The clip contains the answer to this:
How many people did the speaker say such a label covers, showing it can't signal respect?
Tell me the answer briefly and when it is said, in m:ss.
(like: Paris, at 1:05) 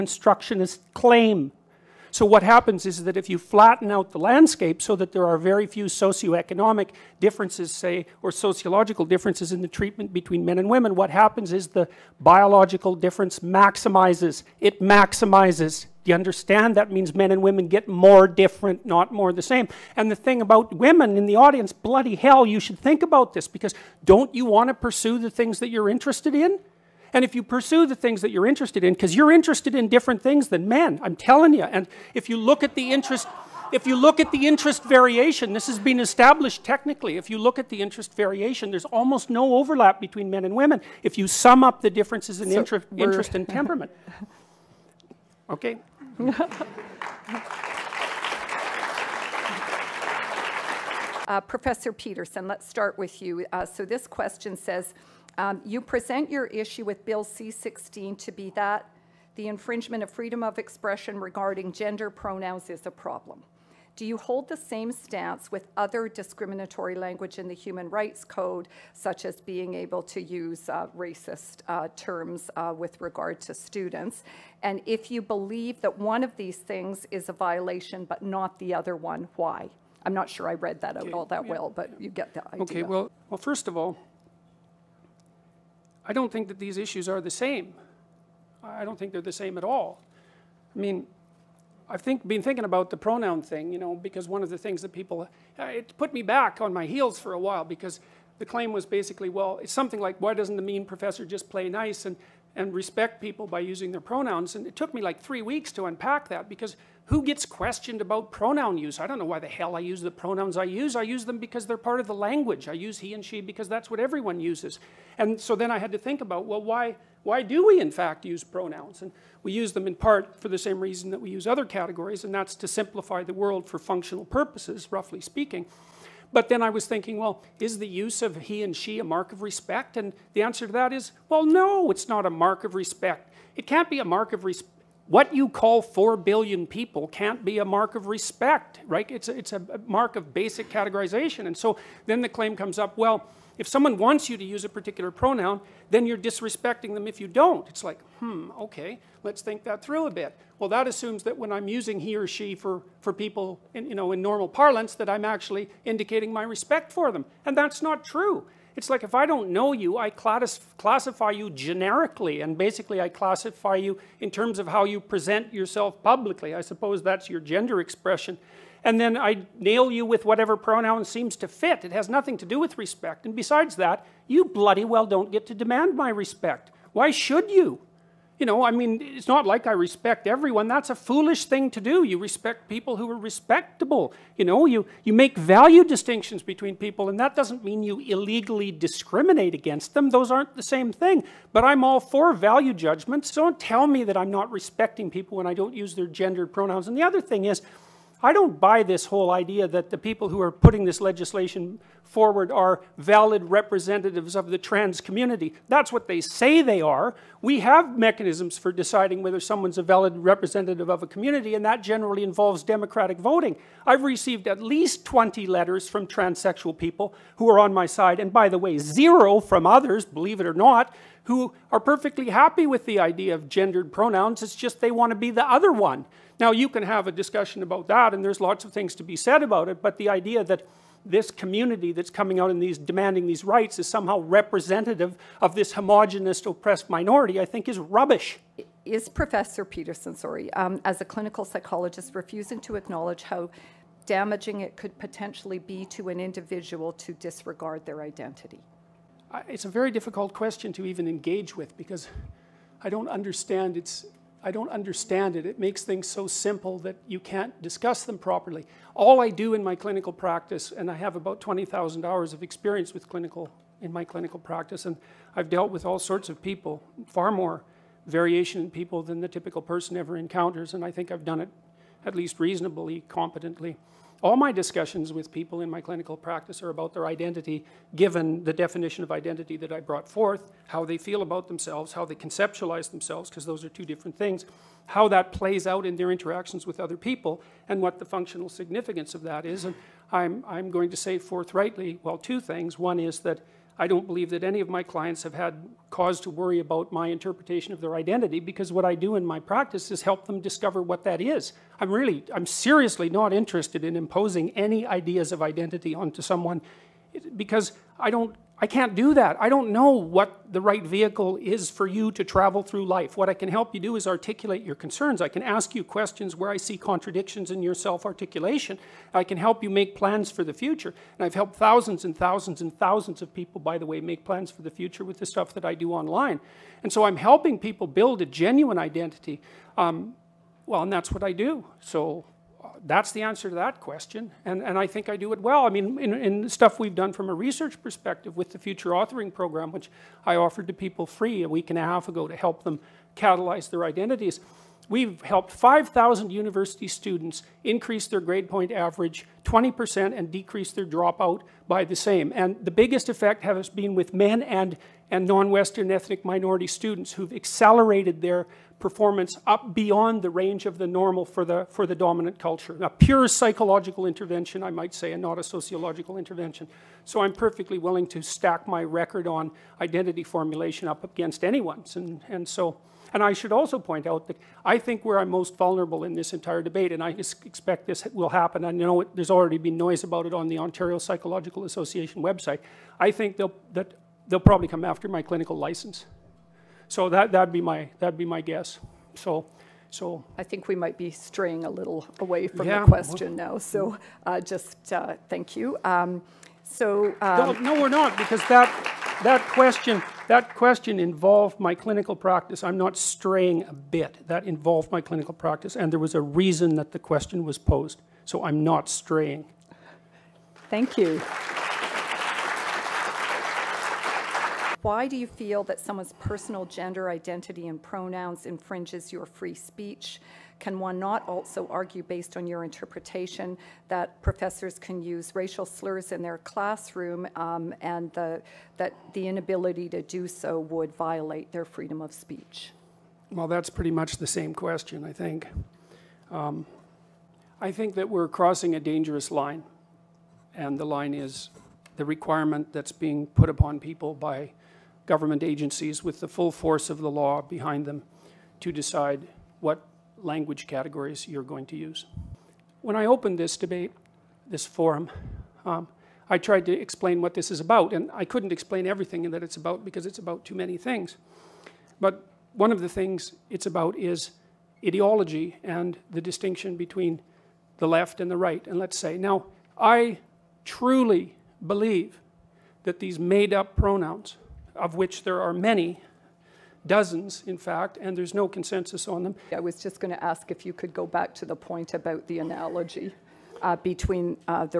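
4 billion, at 2:15.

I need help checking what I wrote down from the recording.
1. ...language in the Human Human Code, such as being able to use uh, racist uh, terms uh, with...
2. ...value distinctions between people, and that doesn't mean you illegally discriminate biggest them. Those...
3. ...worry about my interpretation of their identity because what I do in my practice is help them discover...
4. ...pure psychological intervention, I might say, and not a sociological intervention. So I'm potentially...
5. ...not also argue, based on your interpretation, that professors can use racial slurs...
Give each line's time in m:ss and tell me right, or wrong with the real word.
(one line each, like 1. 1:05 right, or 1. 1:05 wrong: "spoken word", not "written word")
1. 1:06 wrong: "Rights", not "Human"
2. 3:05 wrong: "against", not "biggest"
3. 4:56 right
4. 6:02 wrong: "perfectly", not "potentially"
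5. 7:00 right.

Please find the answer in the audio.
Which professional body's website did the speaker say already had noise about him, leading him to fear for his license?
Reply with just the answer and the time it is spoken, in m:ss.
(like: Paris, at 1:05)
Ontario Psychological Association, at 6:20.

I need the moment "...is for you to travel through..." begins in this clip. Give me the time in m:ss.
5:11.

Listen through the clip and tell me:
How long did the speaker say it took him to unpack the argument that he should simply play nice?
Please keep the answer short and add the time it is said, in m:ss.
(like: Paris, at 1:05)
3 weeks, at 1:45.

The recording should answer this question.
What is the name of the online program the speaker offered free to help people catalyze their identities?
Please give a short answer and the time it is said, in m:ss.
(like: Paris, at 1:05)
Future Authoring Program, at 5:38.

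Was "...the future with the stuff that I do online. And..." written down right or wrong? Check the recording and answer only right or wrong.
right.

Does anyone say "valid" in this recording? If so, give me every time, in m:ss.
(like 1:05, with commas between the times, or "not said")
3:22, 3:29.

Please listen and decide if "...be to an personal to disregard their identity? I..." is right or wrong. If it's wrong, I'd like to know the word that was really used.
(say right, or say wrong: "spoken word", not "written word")
wrong: "individual", not "personal".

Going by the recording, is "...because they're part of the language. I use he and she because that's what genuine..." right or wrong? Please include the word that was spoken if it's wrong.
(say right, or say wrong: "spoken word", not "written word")
wrong: "everyone", not "genuine".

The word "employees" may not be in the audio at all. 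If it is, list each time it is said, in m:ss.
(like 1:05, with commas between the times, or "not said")
not said.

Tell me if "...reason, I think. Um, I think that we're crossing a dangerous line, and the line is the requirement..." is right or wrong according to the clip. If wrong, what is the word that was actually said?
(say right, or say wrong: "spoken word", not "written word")
wrong: "question", not "reason".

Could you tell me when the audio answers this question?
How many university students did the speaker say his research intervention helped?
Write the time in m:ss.
5:45.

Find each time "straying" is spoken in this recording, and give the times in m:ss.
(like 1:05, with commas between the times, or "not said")
6:31, 6:42, 6:48.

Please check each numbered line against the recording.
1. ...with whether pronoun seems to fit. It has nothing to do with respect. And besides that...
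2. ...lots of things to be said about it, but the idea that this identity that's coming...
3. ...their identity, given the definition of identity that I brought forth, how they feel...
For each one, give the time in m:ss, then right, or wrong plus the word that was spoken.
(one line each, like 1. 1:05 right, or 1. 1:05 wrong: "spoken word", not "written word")
1. 2:50 wrong: "whatever", not "whether"
2. 3:48 wrong: "community", not "identity"
3. 4:36 right.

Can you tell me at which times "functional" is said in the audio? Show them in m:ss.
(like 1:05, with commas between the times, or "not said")
2:03, 4:48.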